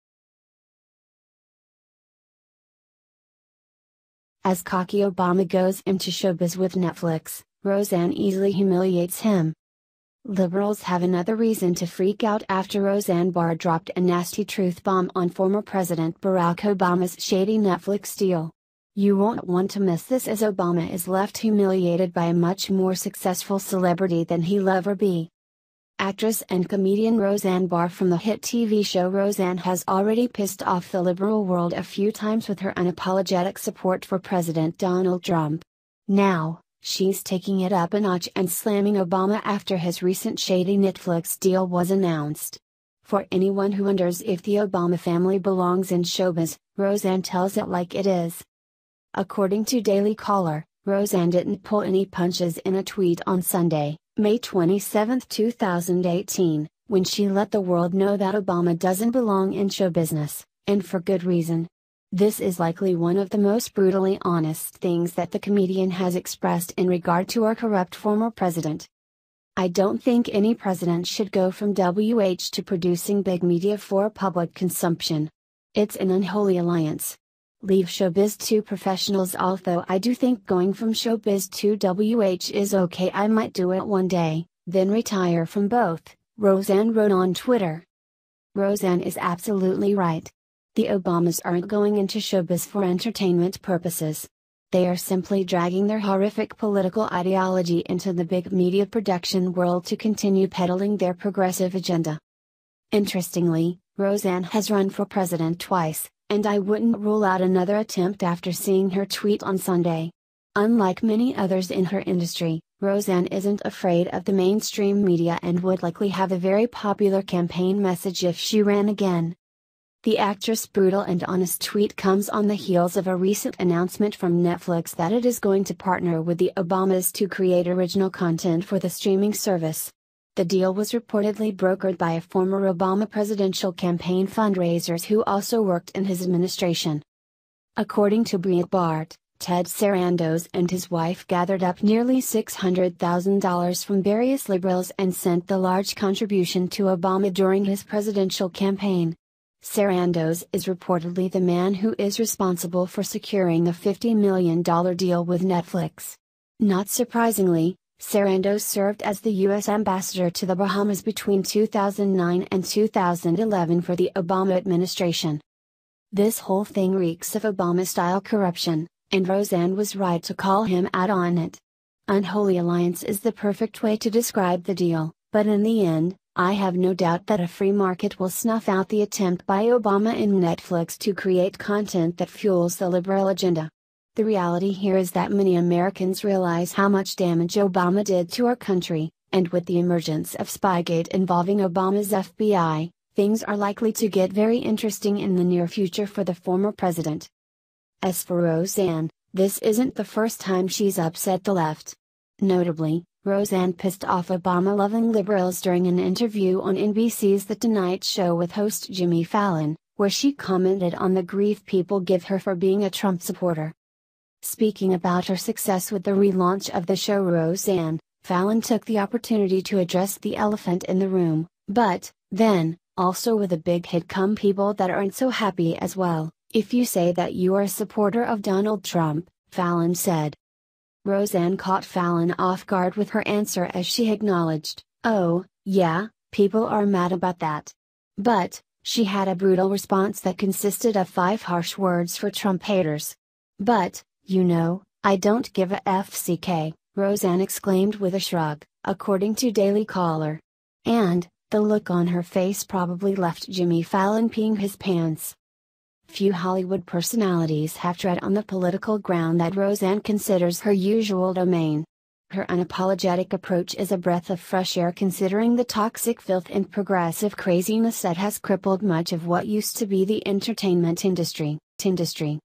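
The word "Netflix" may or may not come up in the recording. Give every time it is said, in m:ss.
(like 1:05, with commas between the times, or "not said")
0:06, 0:17, 0:40, 2:04, 2:35, 3:00.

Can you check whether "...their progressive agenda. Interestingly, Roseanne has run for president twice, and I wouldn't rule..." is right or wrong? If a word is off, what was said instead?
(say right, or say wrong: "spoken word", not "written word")
right.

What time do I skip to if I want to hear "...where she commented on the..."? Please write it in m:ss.
3:29.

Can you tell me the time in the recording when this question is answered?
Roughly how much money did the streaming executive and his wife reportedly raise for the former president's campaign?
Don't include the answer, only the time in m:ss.
2:22.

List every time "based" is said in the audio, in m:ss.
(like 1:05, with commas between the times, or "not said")
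not said.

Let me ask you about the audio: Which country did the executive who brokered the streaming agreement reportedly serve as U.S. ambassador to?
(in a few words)
Bahamas.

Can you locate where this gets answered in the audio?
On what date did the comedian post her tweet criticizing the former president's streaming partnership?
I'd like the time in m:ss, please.
0:54.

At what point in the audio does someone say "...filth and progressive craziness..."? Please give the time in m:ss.
4:26.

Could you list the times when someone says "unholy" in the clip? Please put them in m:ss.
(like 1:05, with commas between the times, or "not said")
1:16, 2:52.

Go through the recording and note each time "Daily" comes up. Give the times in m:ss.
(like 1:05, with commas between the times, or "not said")
0:49, 4:09.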